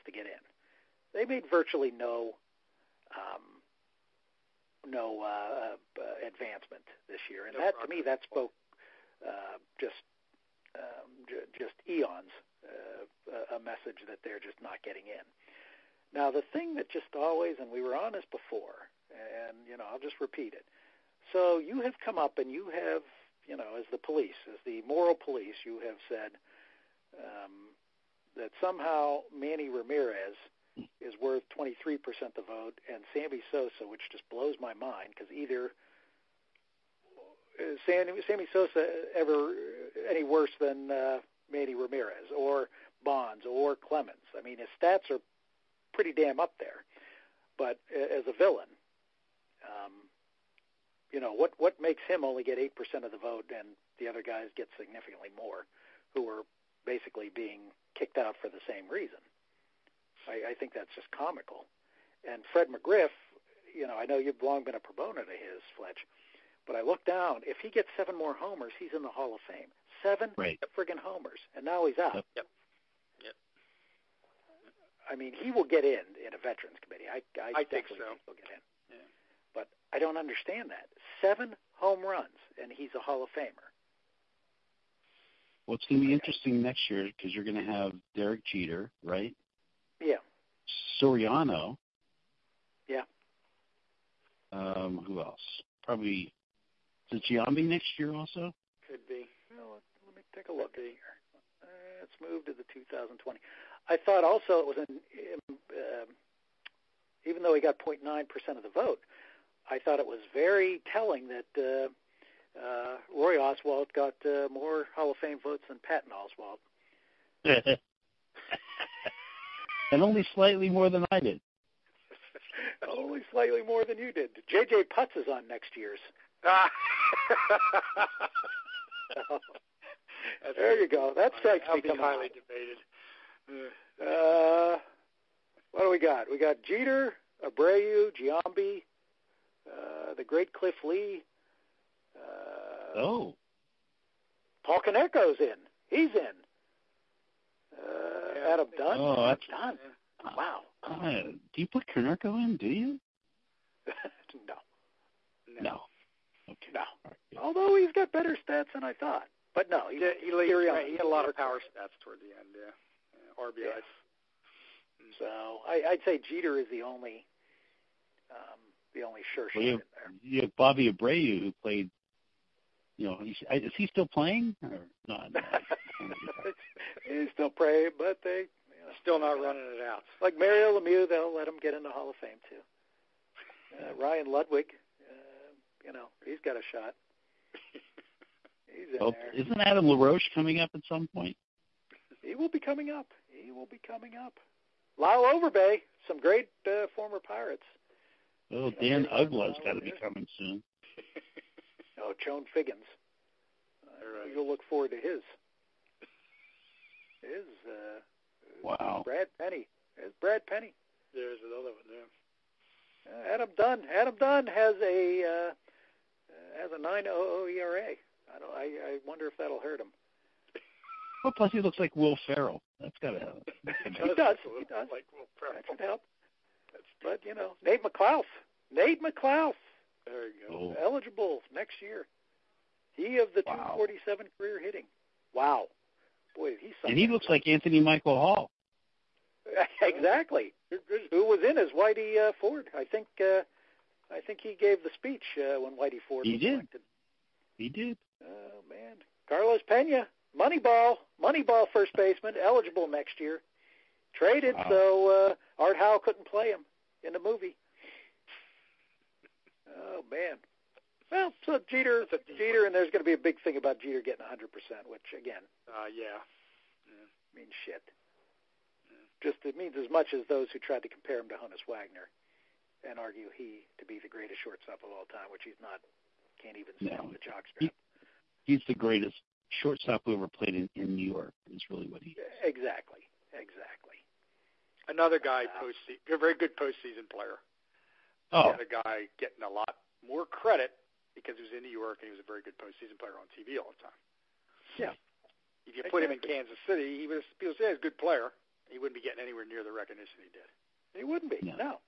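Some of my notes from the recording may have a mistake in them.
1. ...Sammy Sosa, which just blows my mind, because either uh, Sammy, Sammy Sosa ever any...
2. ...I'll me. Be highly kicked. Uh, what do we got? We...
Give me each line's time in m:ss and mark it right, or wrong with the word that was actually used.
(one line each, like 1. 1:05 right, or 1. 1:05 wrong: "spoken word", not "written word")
1. 0:33 right
2. 2:11 wrong: "debated", not "kicked".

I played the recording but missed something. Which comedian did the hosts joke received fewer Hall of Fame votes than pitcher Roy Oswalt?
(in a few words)
Patton Oswalt.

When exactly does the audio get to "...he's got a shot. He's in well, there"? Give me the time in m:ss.
3:06.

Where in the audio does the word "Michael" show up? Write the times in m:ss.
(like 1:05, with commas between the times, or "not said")
3:57.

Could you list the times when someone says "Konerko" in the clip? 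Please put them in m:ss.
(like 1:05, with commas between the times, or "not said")
2:24, 2:31.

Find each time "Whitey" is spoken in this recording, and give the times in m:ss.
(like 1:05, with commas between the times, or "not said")
4:01, 4:05.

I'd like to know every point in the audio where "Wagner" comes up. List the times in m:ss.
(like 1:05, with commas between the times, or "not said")
4:31.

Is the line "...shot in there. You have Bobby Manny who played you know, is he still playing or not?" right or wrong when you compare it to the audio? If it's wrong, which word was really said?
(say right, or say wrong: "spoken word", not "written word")
wrong: "Abreu", not "Manny".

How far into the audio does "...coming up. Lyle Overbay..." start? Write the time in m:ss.
3:13.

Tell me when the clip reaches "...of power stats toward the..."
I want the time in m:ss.
2:41.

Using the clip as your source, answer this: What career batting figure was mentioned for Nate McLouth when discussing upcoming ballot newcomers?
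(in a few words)
247.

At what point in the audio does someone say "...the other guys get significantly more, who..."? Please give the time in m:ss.
0:53.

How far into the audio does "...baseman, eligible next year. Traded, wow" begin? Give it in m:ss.
4:11.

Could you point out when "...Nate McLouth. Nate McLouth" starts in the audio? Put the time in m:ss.
3:47.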